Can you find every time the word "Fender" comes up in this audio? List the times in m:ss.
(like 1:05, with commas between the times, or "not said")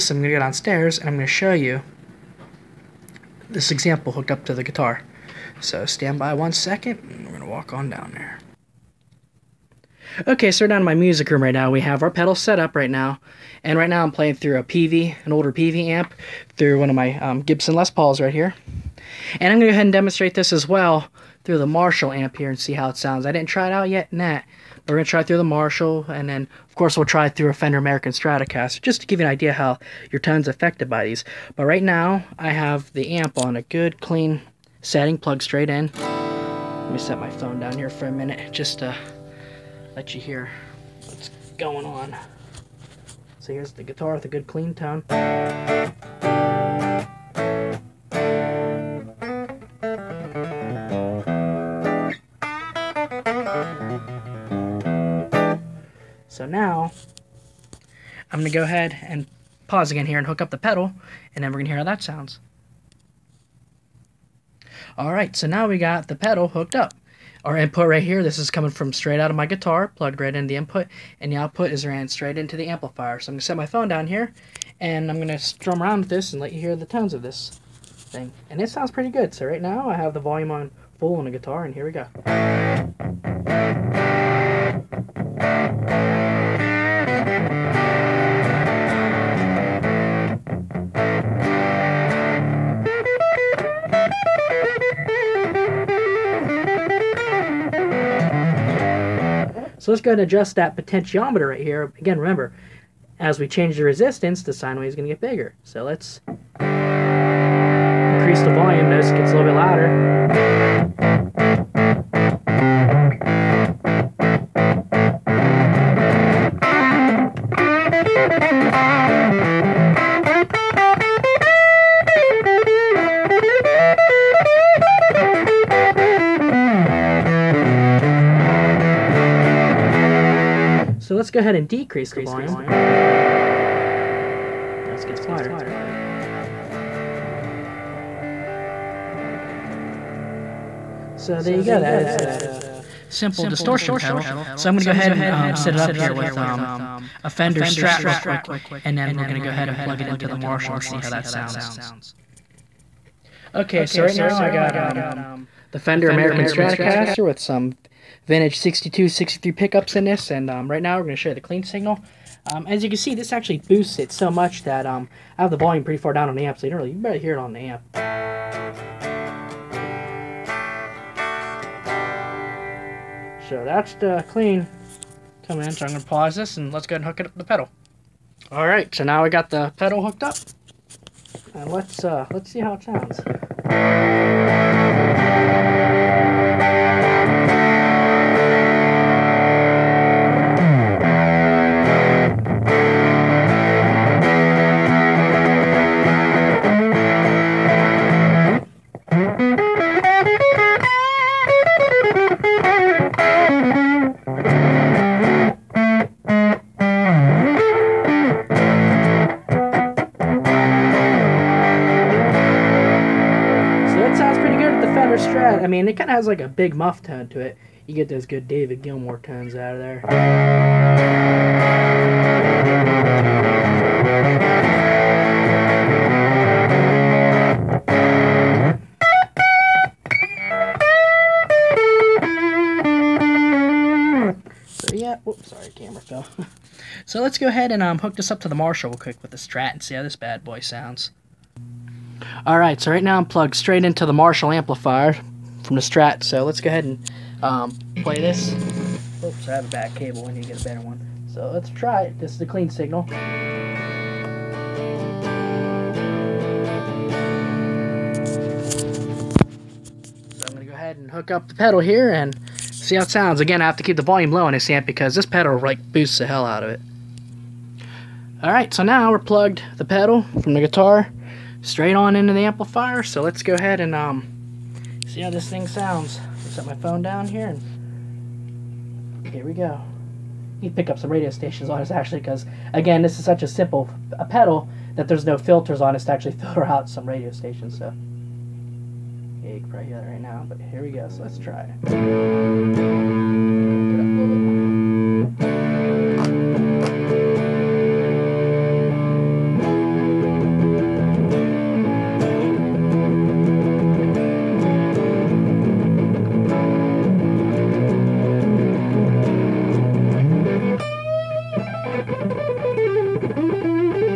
0:27, 2:27, 2:35, 3:34.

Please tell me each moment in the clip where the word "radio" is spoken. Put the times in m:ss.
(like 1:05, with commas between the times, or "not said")
4:41, 4:47.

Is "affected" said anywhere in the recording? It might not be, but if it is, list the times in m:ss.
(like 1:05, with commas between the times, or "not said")
0:30.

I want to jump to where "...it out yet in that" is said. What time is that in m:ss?
0:23.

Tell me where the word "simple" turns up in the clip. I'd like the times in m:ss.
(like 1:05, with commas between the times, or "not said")
2:23, 4:43.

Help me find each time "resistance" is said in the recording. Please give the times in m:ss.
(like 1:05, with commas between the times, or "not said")
1:43.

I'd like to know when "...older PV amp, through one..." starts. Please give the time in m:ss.
0:15.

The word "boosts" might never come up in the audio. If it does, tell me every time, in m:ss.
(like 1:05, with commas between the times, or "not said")
2:43, 4:25.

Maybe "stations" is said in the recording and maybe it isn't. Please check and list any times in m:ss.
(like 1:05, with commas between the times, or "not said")
4:41, 4:47.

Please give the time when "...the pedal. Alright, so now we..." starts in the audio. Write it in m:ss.
2:57.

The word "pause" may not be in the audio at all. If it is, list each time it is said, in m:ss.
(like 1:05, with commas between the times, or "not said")
0:59, 2:56.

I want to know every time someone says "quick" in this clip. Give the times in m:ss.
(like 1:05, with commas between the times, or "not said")
2:28, 3:58.